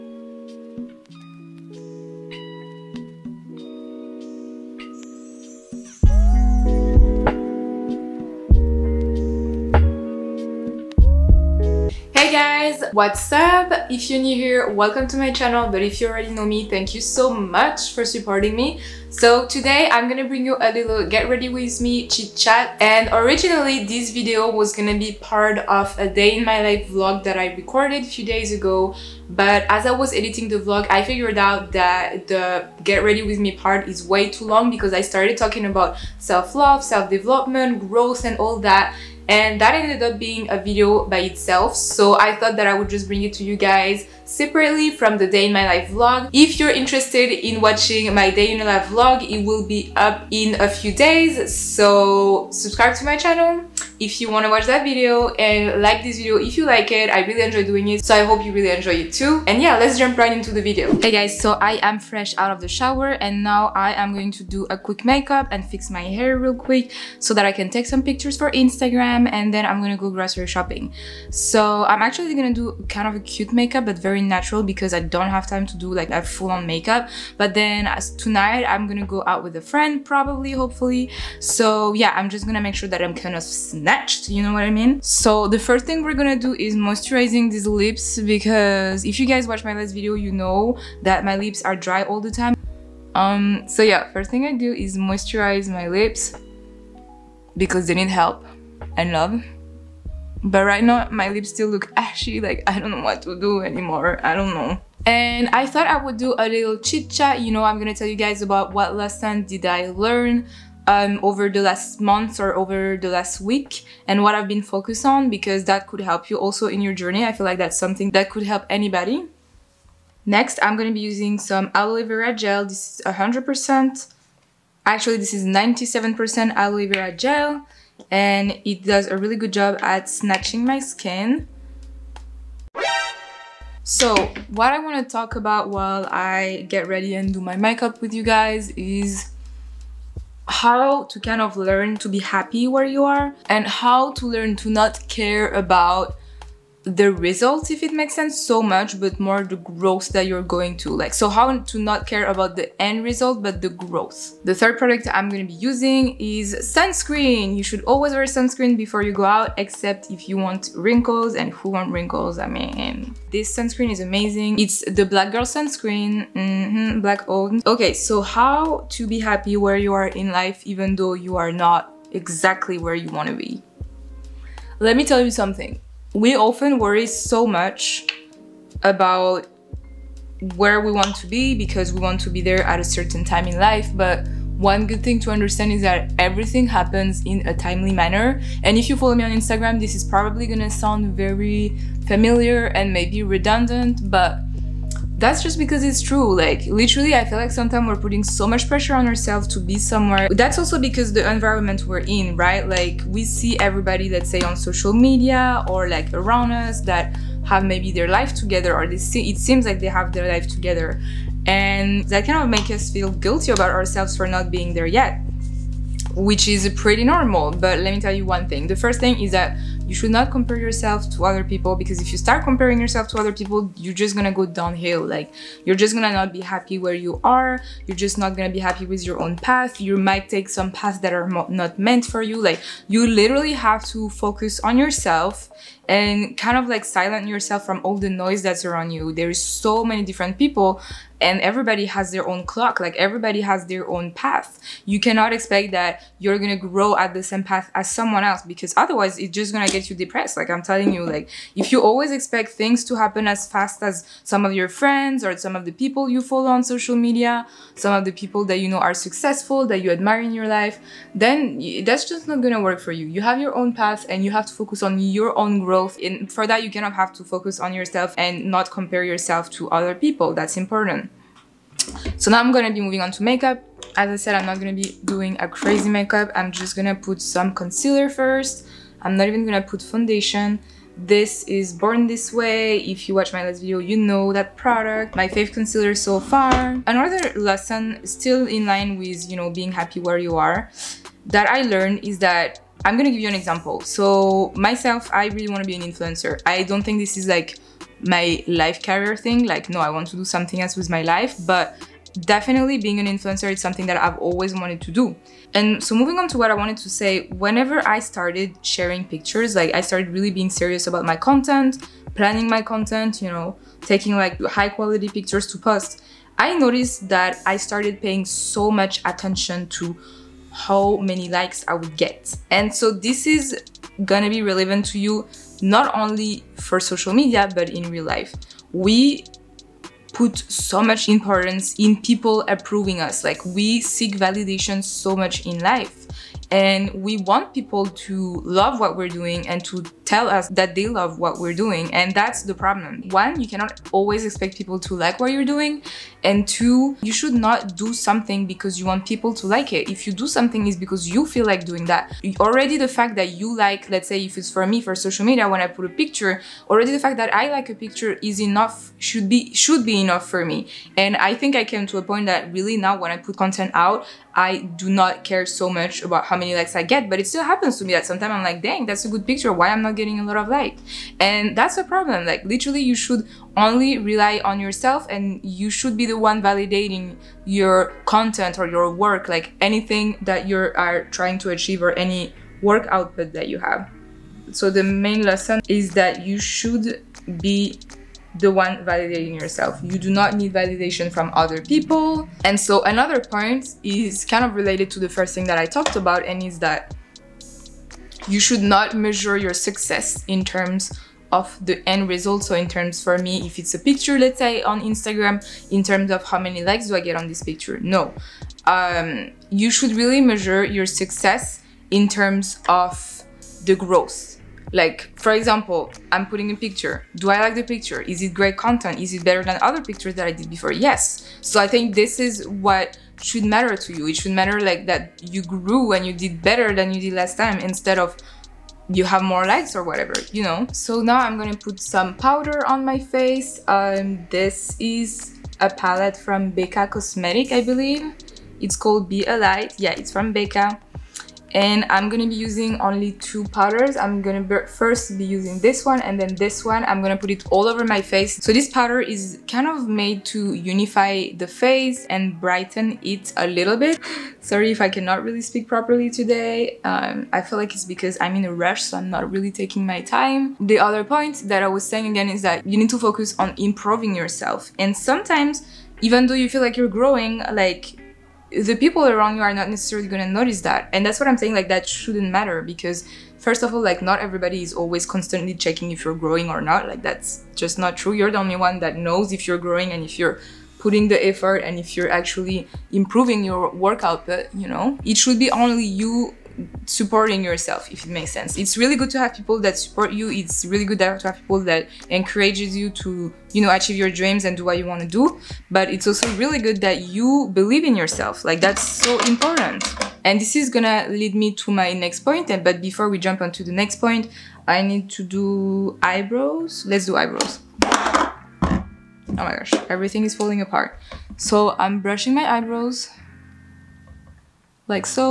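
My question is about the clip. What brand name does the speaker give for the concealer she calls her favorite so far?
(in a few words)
Born This Way.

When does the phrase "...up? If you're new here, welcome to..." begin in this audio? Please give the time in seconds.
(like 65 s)
13 s.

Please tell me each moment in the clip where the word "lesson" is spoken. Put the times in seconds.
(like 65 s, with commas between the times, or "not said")
108 s, 287 s, 385 s.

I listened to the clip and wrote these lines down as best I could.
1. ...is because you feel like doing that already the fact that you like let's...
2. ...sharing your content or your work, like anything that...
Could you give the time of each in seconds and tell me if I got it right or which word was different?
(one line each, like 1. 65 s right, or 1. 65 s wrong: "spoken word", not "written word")
1. 350 s right
2. 376 s wrong: "validating", not "sharing".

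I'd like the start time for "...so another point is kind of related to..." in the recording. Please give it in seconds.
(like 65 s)
392 s.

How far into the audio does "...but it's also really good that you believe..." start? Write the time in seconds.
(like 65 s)
495 s.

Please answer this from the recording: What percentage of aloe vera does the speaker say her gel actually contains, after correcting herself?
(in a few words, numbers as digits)
97%.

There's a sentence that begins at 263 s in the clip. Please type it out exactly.
You have your own path and you have to focus on your own growth.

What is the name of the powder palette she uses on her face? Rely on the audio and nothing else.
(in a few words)
Be a Light.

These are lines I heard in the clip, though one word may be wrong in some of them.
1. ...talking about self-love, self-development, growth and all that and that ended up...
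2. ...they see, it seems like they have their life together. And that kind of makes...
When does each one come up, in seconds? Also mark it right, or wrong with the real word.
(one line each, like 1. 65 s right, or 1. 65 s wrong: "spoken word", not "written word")
1. 35 s right
2. 208 s right.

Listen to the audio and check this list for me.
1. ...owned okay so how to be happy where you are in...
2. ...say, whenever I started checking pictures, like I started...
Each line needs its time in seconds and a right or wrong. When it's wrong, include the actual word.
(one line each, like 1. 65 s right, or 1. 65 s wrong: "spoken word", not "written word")
1. 167 s right
2. 306 s wrong: "sharing", not "checking".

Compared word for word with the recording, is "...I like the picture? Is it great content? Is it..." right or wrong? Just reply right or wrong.
right.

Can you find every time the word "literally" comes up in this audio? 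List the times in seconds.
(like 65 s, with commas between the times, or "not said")
196 s, 233 s, 372 s.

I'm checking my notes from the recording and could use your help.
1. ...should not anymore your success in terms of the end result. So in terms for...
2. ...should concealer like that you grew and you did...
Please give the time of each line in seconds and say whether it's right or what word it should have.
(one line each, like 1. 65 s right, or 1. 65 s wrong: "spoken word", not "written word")
1. 398 s wrong: "measure", not "anymore"
2. 424 s wrong: "matter", not "concealer".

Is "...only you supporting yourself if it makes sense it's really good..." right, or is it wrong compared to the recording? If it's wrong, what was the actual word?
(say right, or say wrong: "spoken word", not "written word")
right.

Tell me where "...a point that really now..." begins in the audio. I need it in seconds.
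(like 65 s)
361 s.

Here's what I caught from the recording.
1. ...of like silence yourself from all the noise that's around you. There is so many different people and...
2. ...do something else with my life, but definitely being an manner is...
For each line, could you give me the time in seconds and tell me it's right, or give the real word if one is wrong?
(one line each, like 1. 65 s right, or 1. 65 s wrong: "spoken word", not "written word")
1. 236 s right
2. 300 s wrong: "influencer", not "manner".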